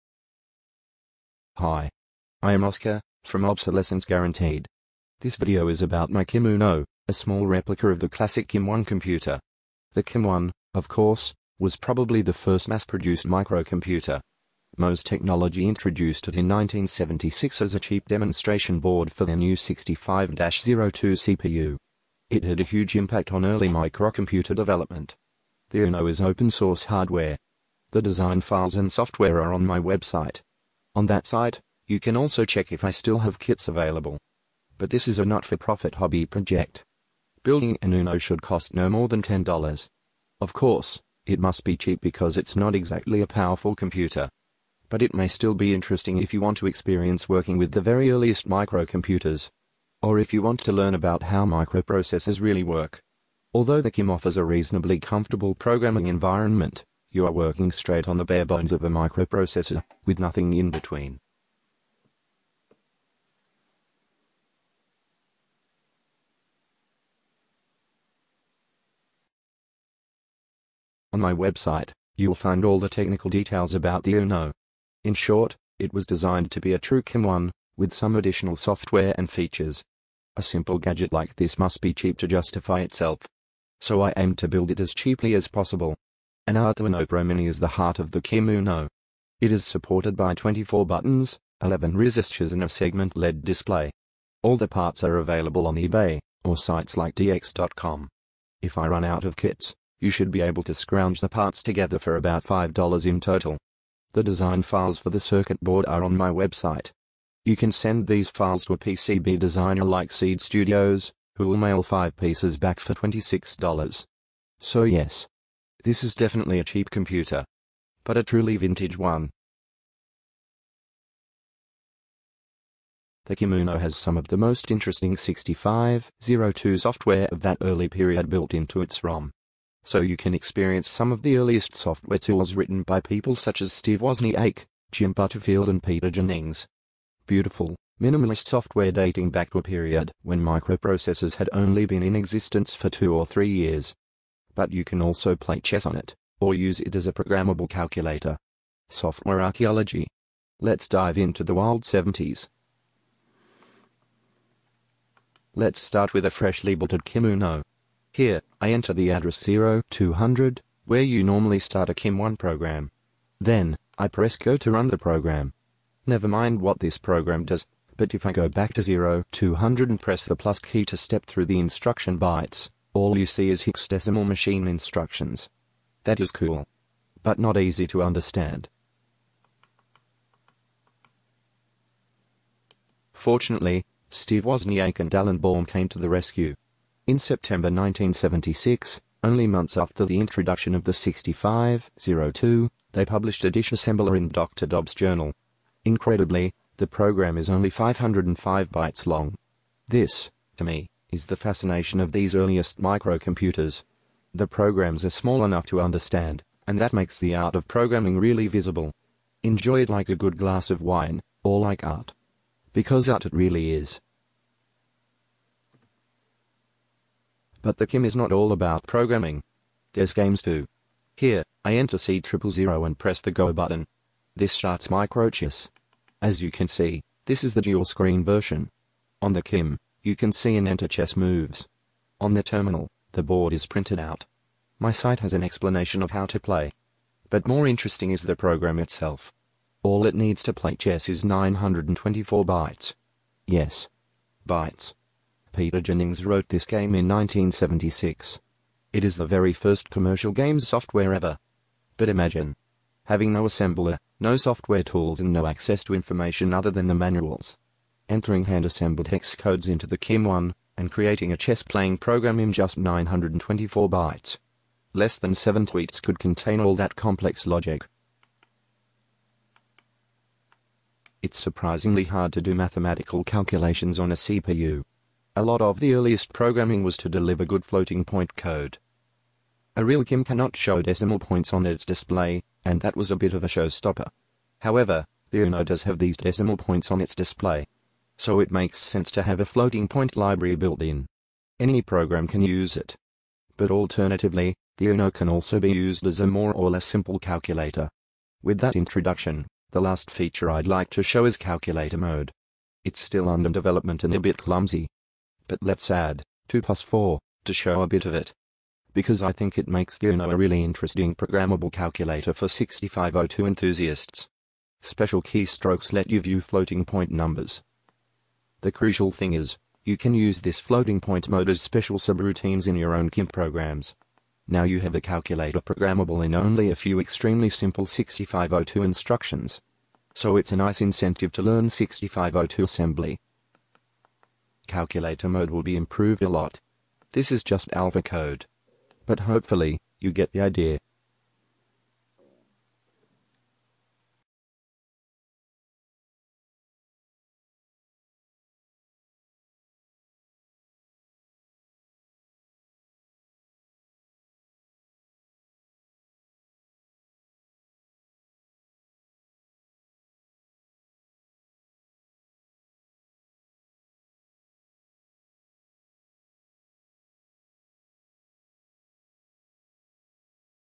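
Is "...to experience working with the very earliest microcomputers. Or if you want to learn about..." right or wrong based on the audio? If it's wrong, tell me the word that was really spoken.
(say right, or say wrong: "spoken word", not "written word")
right.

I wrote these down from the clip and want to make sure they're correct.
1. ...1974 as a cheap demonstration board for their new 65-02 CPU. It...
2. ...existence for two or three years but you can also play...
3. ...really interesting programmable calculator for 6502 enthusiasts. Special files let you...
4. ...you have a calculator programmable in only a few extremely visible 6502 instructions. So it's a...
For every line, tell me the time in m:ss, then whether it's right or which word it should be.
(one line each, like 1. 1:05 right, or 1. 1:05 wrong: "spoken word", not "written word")
1. 0:16 wrong: "1976", not "1974"
2. 2:22 right
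3. 5:10 wrong: "keystrokes", not "files"
4. 5:24 wrong: "simple", not "visible".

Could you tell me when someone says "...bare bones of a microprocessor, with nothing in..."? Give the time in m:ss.
0:58.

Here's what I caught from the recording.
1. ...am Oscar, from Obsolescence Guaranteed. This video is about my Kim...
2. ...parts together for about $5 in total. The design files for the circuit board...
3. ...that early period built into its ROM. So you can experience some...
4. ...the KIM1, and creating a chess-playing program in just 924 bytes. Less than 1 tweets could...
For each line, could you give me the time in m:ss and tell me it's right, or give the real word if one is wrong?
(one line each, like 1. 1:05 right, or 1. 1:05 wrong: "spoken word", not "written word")
1. 0:02 right
2. 1:41 right
3. 2:07 right
4. 4:19 wrong: "7", not "1".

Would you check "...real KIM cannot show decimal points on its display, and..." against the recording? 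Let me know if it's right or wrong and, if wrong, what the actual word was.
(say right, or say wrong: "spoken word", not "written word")
right.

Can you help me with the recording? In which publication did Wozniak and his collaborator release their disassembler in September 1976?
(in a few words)
Dr. Dobbs' journal.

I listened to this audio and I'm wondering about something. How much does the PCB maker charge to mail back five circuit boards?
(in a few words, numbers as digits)
$26.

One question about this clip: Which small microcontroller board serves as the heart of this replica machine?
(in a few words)
Arduino Pro Mini.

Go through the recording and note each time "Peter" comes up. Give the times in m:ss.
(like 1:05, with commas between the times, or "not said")
2:15, 4:05.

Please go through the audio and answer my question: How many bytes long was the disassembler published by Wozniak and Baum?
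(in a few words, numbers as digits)
505.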